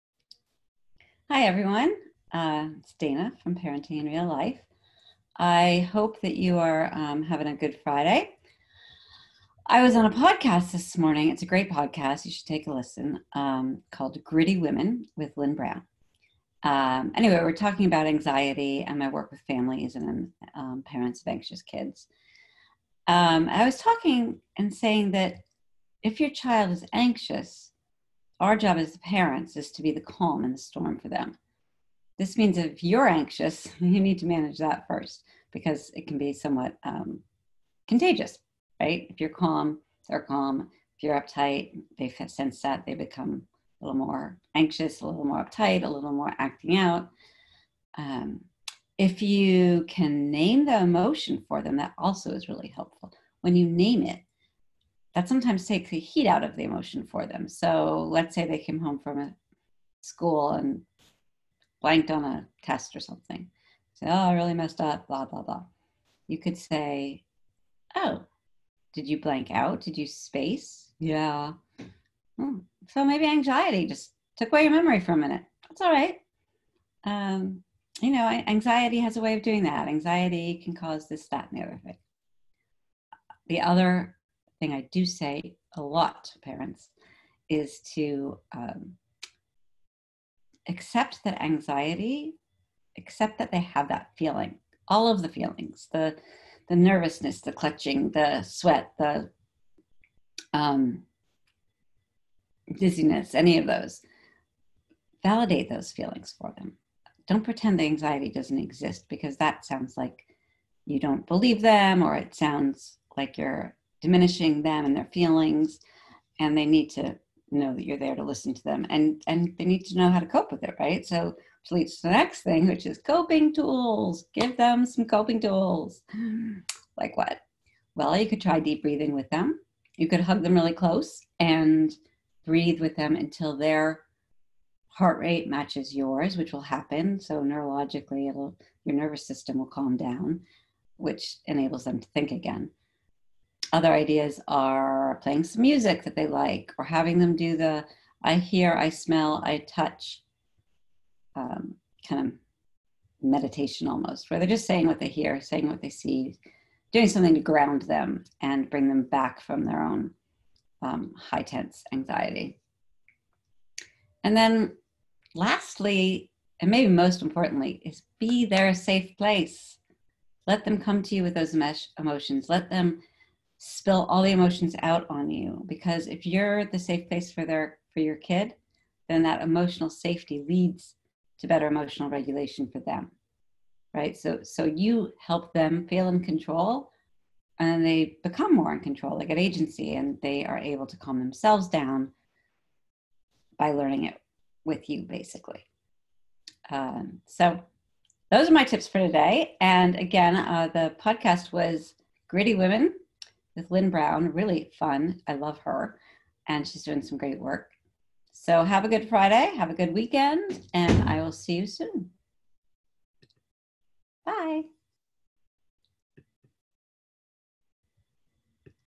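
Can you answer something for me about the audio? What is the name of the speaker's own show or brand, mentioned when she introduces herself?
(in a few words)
Parenting in Real Life.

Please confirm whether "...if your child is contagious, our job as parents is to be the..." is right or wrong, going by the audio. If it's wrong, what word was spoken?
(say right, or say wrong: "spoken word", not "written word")
wrong: "anxious", not "contagious".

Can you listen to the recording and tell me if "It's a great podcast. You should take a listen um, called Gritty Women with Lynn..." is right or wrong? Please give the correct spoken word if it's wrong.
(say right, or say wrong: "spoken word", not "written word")
right.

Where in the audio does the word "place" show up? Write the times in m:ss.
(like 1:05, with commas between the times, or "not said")
2:49, 2:57.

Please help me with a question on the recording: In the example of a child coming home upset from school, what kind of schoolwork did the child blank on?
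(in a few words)
A test.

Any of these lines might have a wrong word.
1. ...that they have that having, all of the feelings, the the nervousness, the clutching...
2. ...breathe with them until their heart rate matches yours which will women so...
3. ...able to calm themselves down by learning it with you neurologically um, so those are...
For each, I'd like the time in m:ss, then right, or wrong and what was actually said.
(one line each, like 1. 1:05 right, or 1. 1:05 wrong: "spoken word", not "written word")
1. 1:33 wrong: "feeling", not "having"
2. 2:12 wrong: "happen", not "women"
3. 3:10 wrong: "basically", not "neurologically".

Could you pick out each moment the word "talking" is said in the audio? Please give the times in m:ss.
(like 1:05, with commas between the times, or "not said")
0:17, 0:23.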